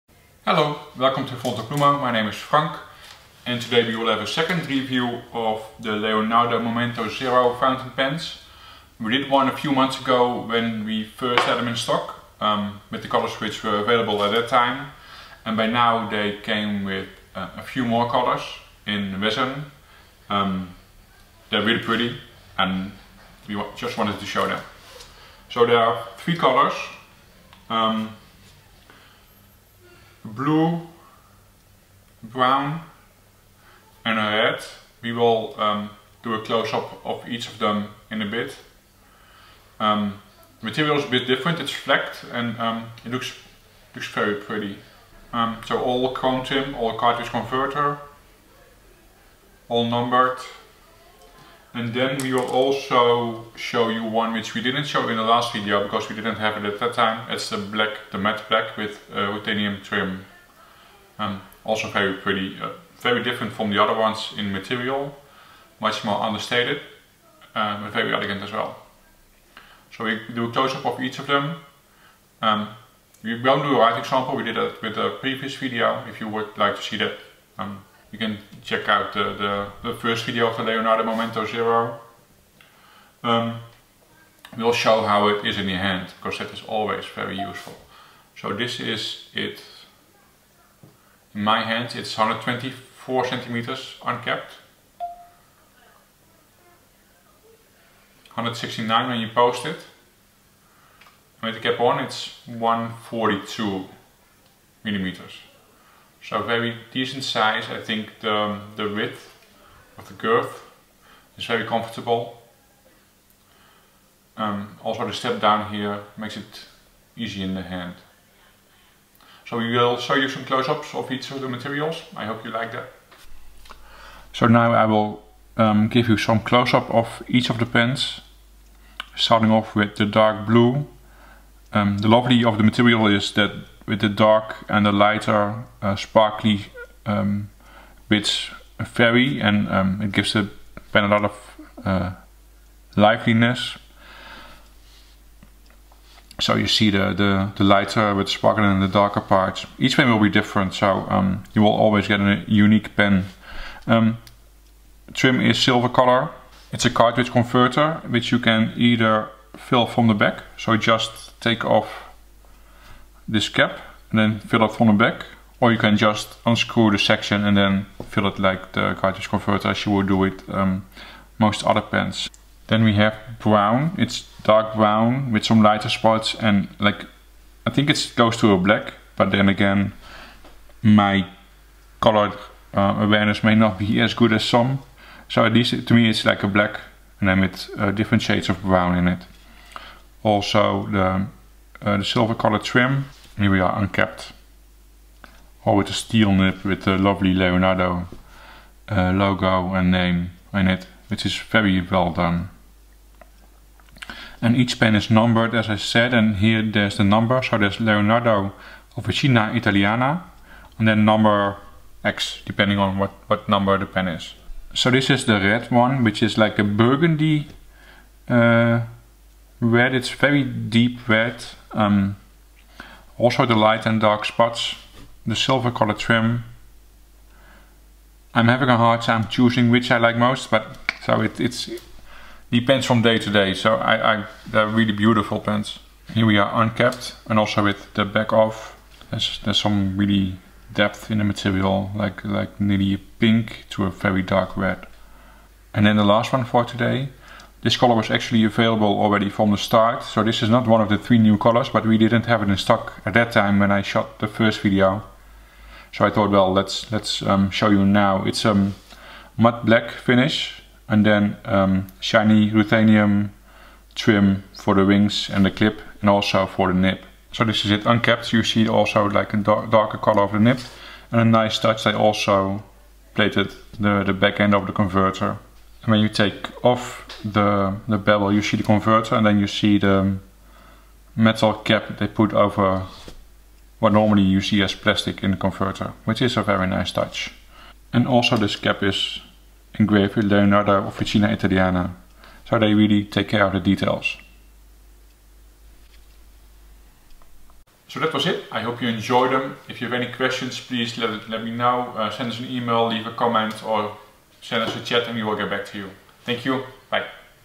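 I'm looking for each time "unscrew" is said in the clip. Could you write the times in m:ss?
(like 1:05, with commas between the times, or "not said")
2:46.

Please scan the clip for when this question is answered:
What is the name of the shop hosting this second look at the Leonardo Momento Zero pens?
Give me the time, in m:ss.
0:01.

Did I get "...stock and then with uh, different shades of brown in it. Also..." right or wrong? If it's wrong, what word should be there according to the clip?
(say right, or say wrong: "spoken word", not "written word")
wrong: "black", not "stock".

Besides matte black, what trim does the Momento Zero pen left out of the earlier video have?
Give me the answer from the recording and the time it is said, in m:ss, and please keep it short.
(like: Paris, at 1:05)
titanium trim, at 0:59.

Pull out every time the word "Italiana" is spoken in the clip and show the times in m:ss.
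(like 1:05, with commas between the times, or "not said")
3:29, 4:51.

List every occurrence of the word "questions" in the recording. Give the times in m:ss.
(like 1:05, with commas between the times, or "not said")
5:00.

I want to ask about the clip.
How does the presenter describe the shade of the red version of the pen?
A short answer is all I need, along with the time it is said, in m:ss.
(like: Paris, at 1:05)
burgundy, at 3:36.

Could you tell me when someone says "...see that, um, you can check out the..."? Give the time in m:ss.
1:16.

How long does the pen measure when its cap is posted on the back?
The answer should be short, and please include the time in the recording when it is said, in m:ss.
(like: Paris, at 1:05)
169, at 1:38.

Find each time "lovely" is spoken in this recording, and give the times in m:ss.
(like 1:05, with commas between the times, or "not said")
2:12, 3:16.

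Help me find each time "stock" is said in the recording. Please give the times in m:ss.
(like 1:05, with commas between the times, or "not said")
0:11, 4:12.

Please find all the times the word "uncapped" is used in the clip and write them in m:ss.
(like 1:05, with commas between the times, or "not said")
1:34, 3:13, 3:56, 4:27.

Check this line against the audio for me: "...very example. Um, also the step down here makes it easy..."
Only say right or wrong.
wrong.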